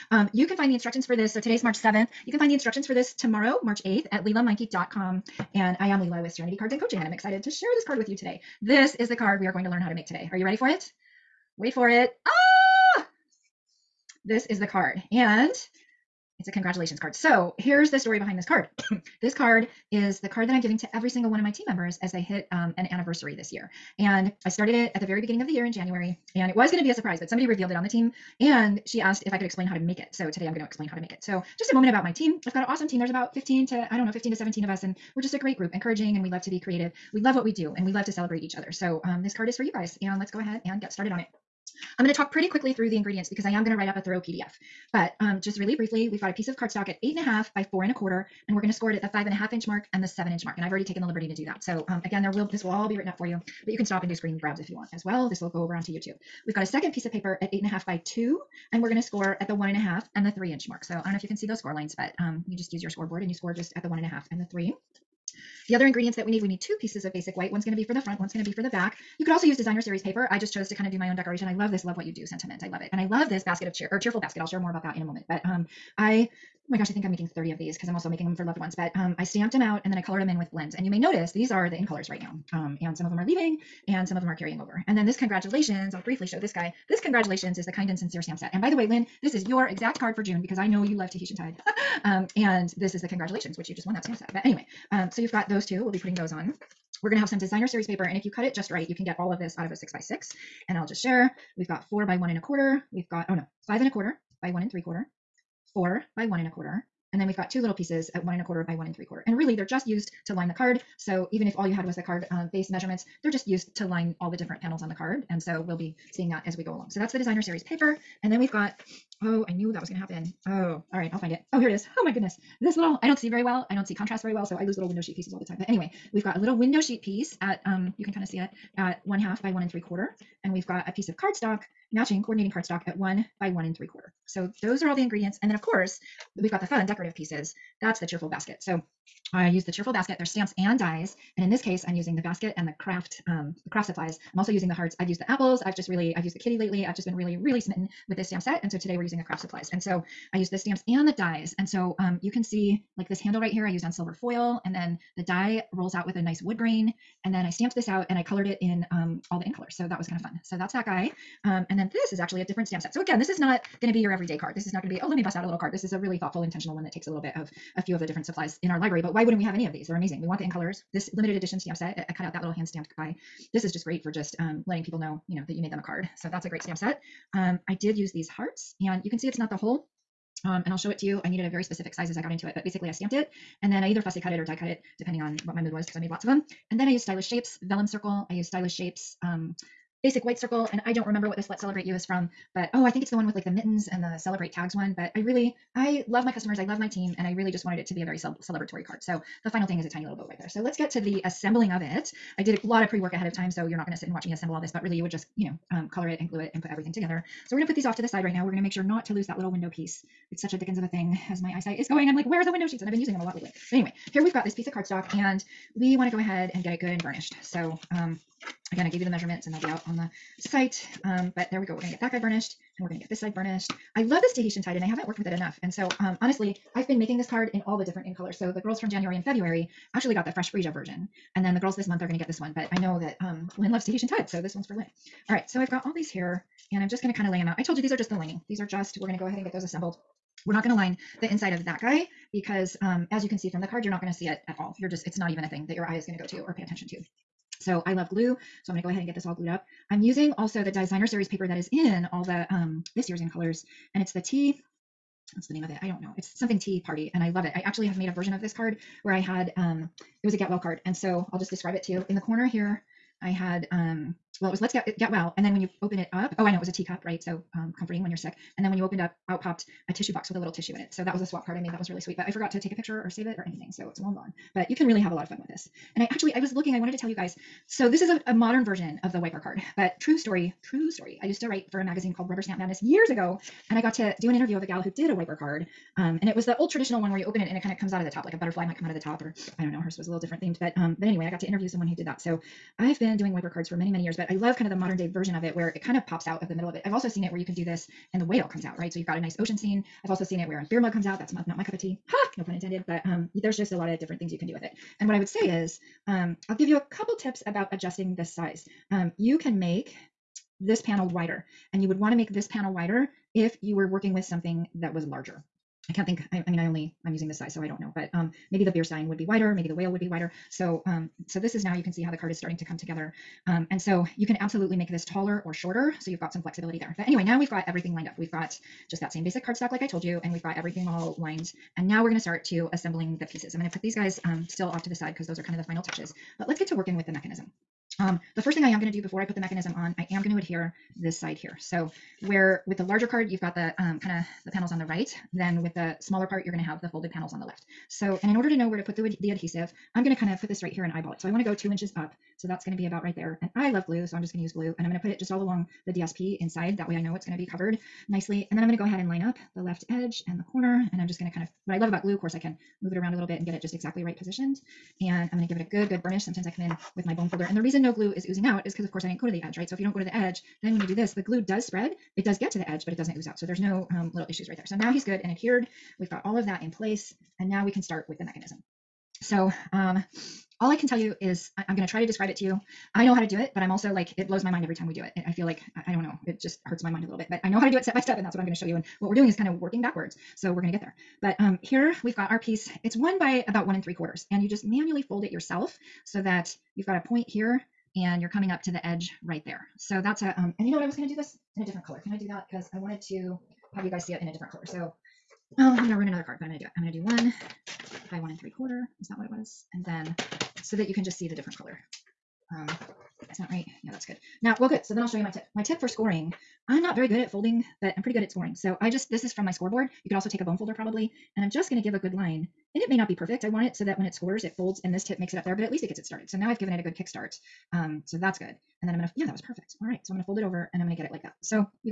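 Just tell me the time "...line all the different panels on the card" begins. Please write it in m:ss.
1:53.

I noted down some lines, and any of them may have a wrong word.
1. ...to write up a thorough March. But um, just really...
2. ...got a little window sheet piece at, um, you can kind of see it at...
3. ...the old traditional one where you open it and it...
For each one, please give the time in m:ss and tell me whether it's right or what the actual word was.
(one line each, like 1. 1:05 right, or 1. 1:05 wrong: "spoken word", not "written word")
1. 0:43 wrong: "PDF", not "March"
2. 2:06 right
3. 4:46 right.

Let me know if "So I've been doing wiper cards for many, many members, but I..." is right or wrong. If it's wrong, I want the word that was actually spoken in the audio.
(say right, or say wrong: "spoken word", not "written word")
wrong: "years", not "members".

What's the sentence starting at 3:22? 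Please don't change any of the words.
I did a lot of pre work ahead of time.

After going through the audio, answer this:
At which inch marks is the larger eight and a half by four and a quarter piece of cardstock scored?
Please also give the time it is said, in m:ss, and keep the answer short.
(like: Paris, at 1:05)
5 1/2 and 7 inches, at 0:49.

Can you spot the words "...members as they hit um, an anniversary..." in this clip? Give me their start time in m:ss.
0:21.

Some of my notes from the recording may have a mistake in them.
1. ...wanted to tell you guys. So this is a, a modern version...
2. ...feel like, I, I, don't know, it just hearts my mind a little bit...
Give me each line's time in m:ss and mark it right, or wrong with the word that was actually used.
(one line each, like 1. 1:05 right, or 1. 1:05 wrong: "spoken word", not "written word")
1. 4:36 right
2. 6:25 wrong: "hurts", not "hearts".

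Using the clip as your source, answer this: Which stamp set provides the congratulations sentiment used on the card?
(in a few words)
Kind and Sincere.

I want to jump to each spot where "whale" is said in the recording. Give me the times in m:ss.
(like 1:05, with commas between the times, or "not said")
4:58, 5:19.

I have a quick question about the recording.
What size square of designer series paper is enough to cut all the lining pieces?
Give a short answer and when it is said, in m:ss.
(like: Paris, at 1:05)
6 by 6, at 1:39.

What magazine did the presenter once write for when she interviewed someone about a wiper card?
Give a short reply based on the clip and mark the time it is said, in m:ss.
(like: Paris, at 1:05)
Rubber Stamp Madness, at 4:42.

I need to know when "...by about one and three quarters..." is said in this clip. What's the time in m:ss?
6:33.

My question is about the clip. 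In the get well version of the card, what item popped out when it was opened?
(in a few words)
a tissue box.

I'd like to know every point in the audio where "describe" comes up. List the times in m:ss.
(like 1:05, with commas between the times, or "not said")
4:21, 6:22.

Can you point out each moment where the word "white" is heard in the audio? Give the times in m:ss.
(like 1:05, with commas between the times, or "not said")
1:07, 3:10.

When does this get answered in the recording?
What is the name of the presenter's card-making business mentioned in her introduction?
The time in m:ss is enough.
0:06.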